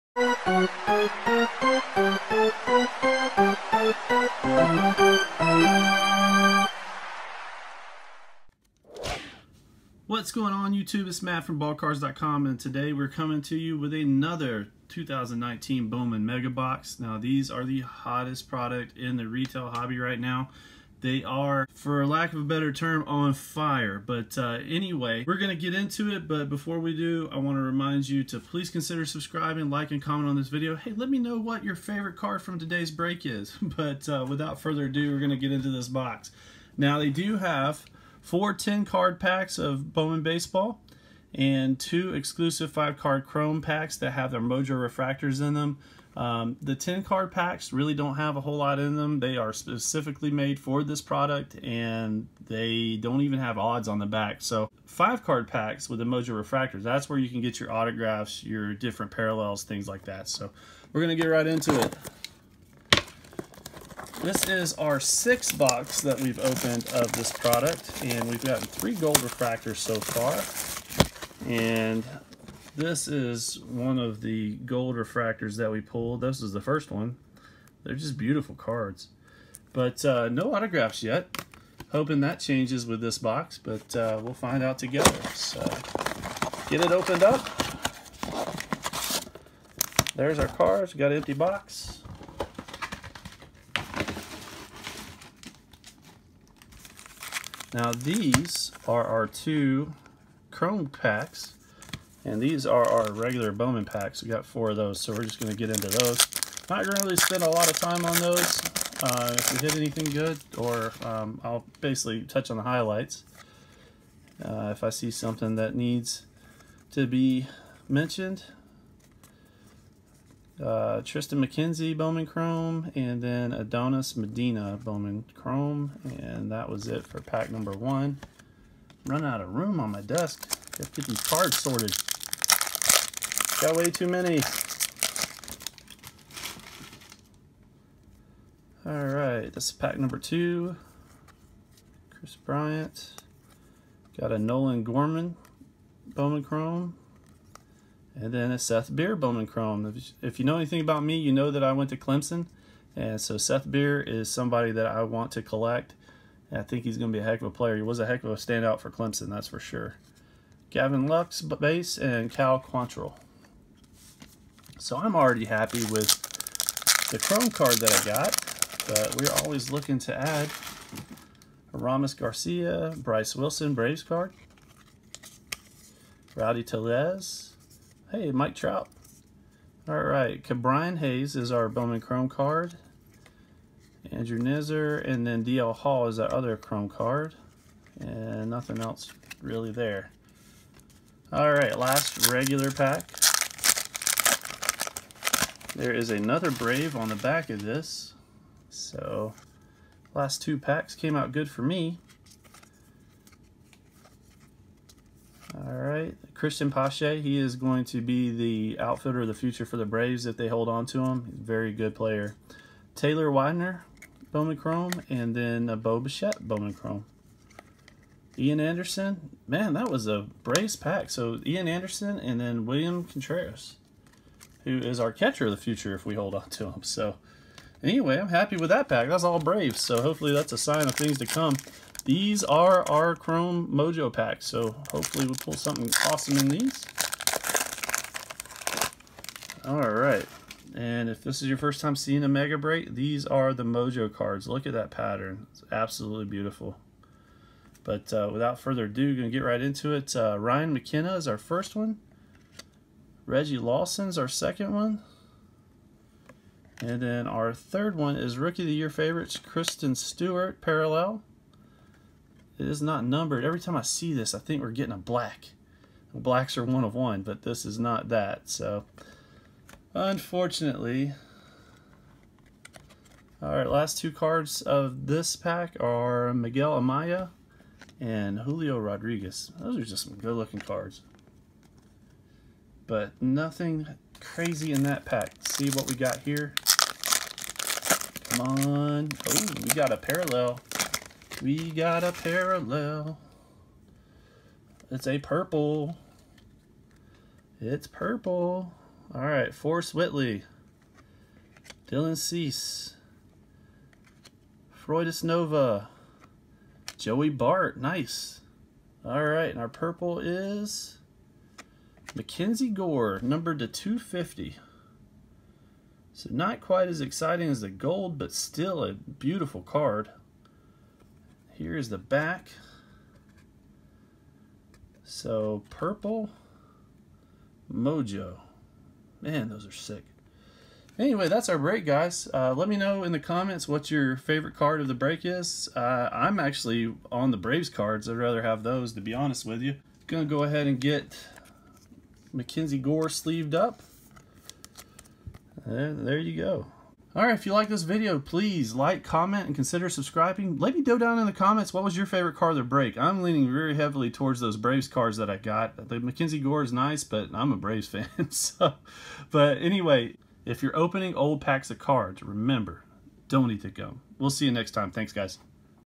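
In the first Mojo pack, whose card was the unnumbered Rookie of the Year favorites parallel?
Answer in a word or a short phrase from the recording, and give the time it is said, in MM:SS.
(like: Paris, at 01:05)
Christin Stewart, at 04:19.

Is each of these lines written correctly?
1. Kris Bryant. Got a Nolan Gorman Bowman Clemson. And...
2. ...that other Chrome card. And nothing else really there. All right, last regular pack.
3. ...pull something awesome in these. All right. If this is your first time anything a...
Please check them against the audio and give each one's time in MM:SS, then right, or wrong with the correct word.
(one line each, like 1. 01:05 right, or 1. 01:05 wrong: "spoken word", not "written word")
1. 02:22 wrong: "Chrome", not "Clemson"
2. 03:06 right
3. 03:55 wrong: "seeing", not "anything".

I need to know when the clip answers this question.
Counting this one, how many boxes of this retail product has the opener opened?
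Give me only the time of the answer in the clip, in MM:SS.
01:04.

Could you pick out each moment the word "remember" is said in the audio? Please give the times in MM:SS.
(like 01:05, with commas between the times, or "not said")
06:02.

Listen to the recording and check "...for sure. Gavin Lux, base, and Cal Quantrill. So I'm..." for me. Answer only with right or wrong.
right.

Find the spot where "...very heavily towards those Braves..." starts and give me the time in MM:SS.
05:53.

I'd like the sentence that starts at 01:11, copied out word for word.
And this is one of the gold refractors that we pulled.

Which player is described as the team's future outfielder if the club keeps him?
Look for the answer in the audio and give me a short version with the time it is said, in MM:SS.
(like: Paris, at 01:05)
Cristian Pache, at 03:26.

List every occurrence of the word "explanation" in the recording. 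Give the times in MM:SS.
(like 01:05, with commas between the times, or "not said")
not said.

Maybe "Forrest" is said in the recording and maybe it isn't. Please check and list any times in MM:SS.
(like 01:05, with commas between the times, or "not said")
04:59.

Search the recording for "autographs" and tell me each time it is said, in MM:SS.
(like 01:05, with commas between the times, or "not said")
00:57, 01:20.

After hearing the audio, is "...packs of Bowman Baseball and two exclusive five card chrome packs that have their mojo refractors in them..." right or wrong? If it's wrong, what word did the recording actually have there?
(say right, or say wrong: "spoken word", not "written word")
right.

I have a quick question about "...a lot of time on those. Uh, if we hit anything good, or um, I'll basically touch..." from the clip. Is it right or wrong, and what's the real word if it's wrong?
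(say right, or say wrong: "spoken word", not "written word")
right.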